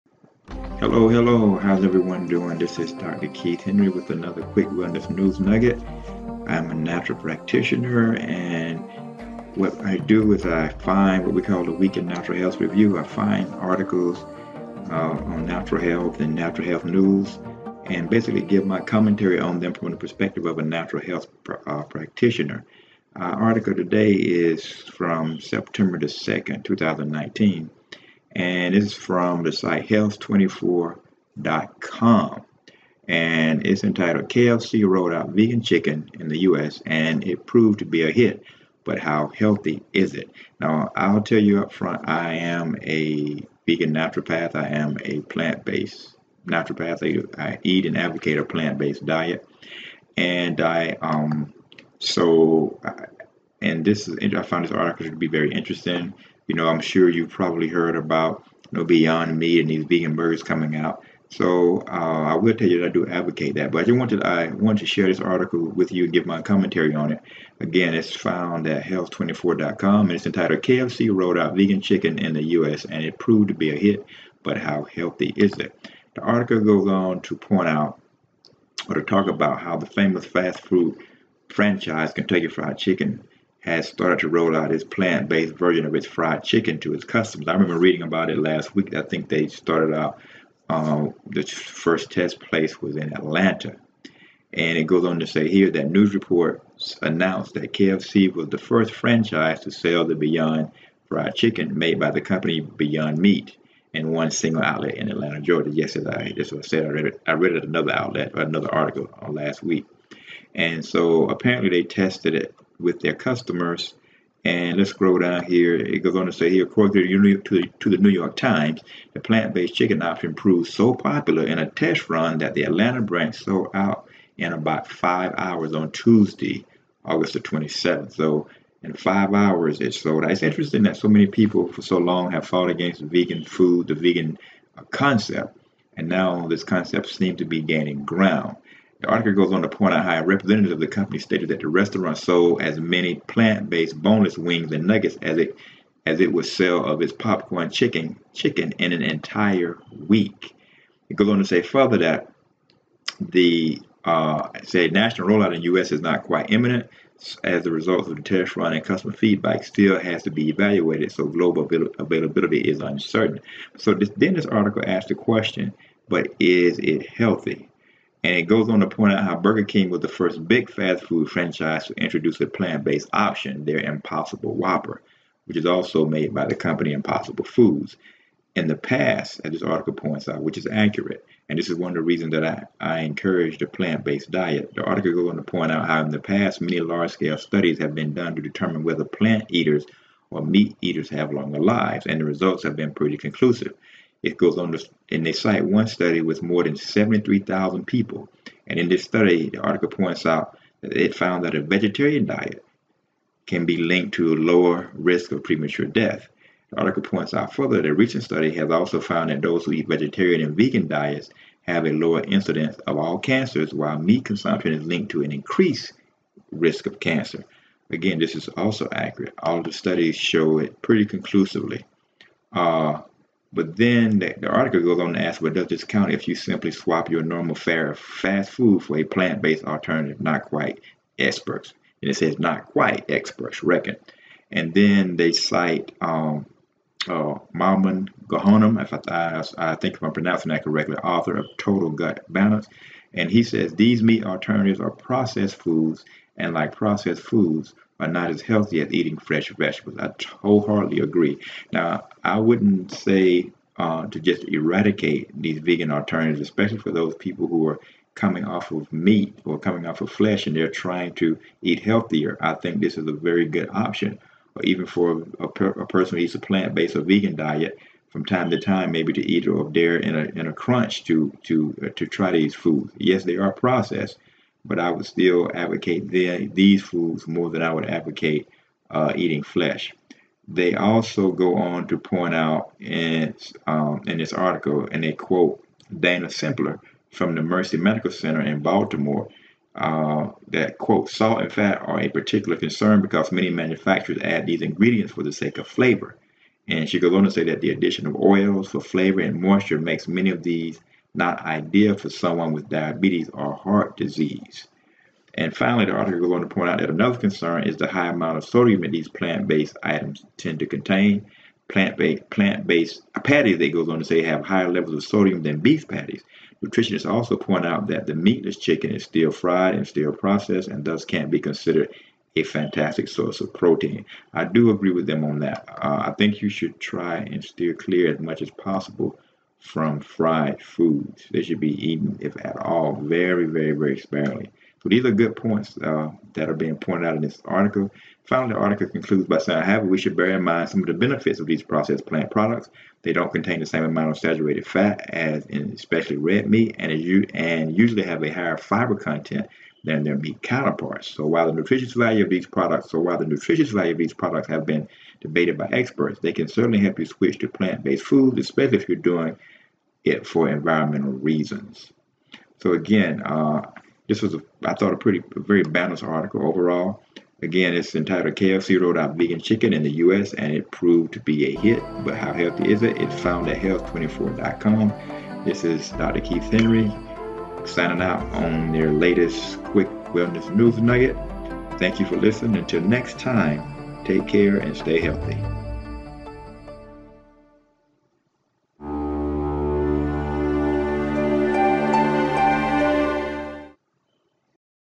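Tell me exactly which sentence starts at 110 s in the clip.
And so apparently they tested it with their customers.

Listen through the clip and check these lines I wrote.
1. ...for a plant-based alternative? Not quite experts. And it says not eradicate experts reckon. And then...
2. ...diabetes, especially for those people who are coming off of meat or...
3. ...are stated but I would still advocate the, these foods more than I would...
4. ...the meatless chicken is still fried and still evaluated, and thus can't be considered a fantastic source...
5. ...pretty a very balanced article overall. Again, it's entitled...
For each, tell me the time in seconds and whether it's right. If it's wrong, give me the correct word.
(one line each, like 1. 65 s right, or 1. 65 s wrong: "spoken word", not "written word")
1. 228 s wrong: "quite", not "eradicate"
2. 255 s wrong: "alternatives", not "diabetes"
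3. 273 s wrong: "processed", not "stated"
4. 318 s wrong: "processed", not "evaluated"
5. 364 s right.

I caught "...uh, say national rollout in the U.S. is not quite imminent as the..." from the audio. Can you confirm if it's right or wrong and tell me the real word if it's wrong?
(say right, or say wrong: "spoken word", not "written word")
right.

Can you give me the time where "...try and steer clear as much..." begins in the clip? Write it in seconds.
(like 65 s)
326 s.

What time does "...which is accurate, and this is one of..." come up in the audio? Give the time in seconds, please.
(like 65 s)
180 s.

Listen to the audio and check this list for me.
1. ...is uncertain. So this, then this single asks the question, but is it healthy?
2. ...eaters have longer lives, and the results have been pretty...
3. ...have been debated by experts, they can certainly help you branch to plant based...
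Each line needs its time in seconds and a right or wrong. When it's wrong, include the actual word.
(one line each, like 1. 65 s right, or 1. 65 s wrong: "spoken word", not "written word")
1. 162 s wrong: "article", not "single"
2. 190 s right
3. 354 s wrong: "switch", not "branch".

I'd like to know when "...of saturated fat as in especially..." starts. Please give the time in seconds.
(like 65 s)
344 s.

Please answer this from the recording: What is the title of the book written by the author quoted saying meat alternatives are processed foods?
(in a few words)
Total Gut Balance.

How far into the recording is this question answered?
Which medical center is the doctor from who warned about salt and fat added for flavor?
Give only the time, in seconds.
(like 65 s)
287 s.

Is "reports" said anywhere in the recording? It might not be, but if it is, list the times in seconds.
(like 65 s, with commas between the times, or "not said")
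96 s.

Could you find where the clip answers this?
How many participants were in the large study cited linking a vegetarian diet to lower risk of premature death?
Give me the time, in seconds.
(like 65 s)
196 s.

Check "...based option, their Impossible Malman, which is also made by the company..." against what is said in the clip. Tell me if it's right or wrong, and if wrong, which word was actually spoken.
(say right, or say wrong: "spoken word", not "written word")
wrong: "Whopper", not "Malman".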